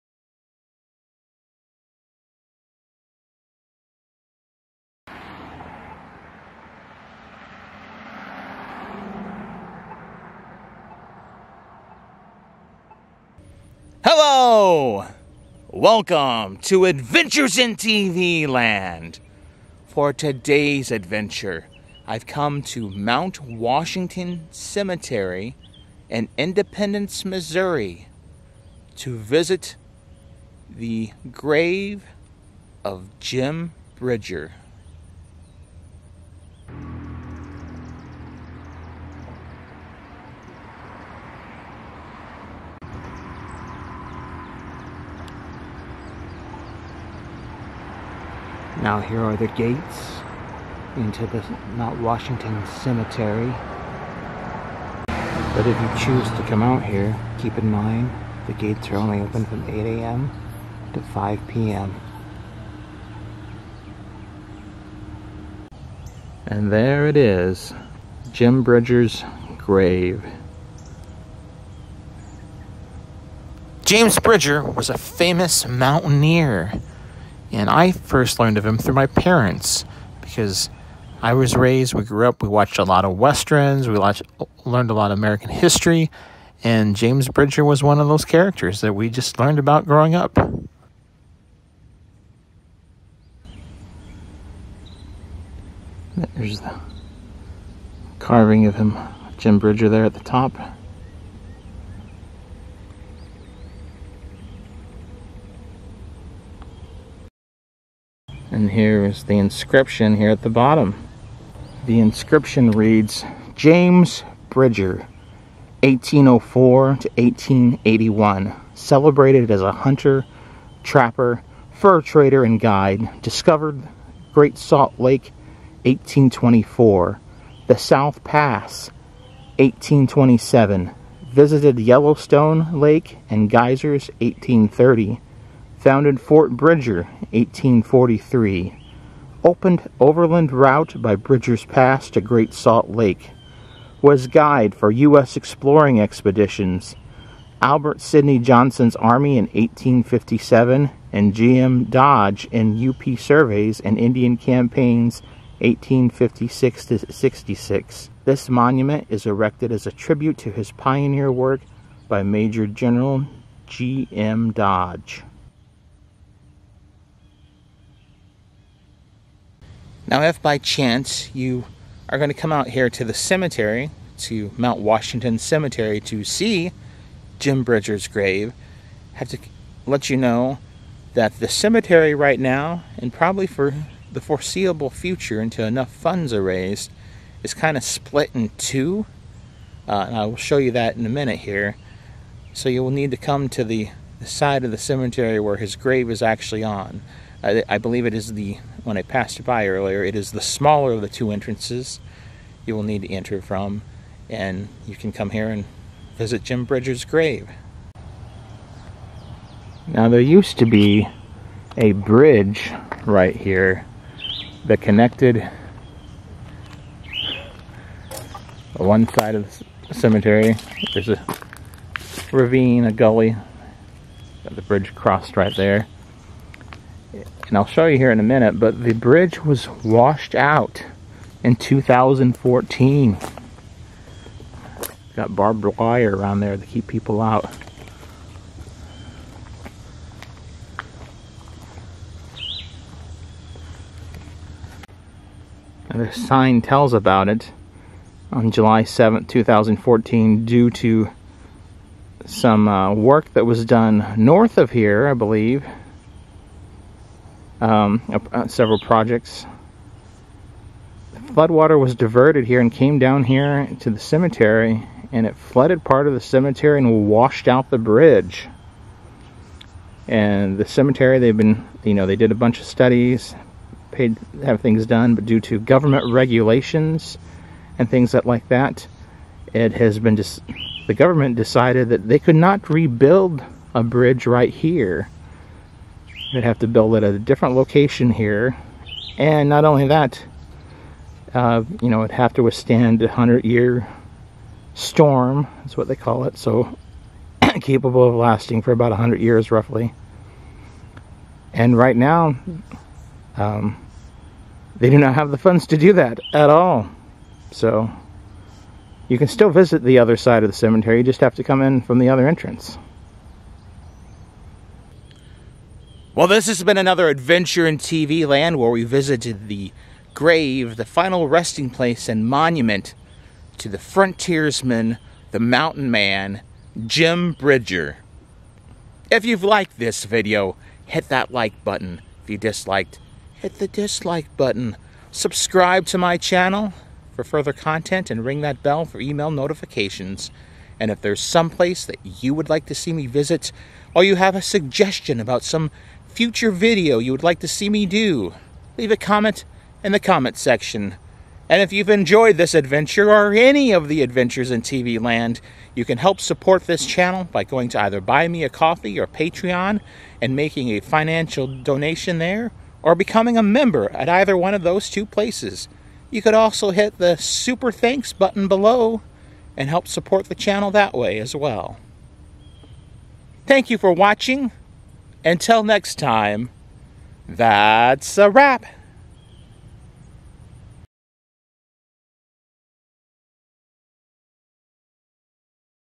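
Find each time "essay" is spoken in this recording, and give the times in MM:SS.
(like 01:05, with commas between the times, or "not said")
not said.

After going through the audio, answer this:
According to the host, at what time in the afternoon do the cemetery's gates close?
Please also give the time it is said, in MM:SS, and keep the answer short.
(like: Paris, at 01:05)
5 p.m., at 01:00.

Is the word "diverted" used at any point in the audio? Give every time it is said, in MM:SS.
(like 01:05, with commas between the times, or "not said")
04:21.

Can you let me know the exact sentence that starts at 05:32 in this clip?
If you disliked, hit the dislike button.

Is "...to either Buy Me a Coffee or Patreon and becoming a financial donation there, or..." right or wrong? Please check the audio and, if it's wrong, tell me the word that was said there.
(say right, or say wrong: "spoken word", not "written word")
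wrong: "making", not "becoming".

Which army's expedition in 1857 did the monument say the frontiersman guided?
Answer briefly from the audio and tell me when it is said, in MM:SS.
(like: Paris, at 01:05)
Albert Sidney Johnston's Army, at 02:27.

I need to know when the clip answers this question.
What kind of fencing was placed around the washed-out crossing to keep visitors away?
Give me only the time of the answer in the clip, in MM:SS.
03:55.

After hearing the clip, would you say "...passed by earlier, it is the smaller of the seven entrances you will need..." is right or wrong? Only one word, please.
wrong.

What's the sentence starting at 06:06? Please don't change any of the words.
You could also hit the Super Thanks button below and help support the channel that way as well.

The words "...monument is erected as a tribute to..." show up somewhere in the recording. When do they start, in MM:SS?
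02:38.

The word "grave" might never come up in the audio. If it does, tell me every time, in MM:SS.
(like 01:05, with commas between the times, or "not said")
00:31, 01:09, 02:58, 03:15, 03:27, 05:20.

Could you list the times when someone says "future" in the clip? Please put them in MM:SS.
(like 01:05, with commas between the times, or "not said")
03:04, 05:46.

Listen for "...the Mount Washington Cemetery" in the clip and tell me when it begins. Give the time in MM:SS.
00:51.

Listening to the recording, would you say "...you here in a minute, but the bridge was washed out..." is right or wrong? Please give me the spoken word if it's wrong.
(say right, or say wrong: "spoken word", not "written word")
right.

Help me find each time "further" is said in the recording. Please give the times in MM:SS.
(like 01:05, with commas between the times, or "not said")
05:37.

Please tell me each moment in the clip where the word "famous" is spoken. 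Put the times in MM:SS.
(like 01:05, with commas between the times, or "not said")
01:14.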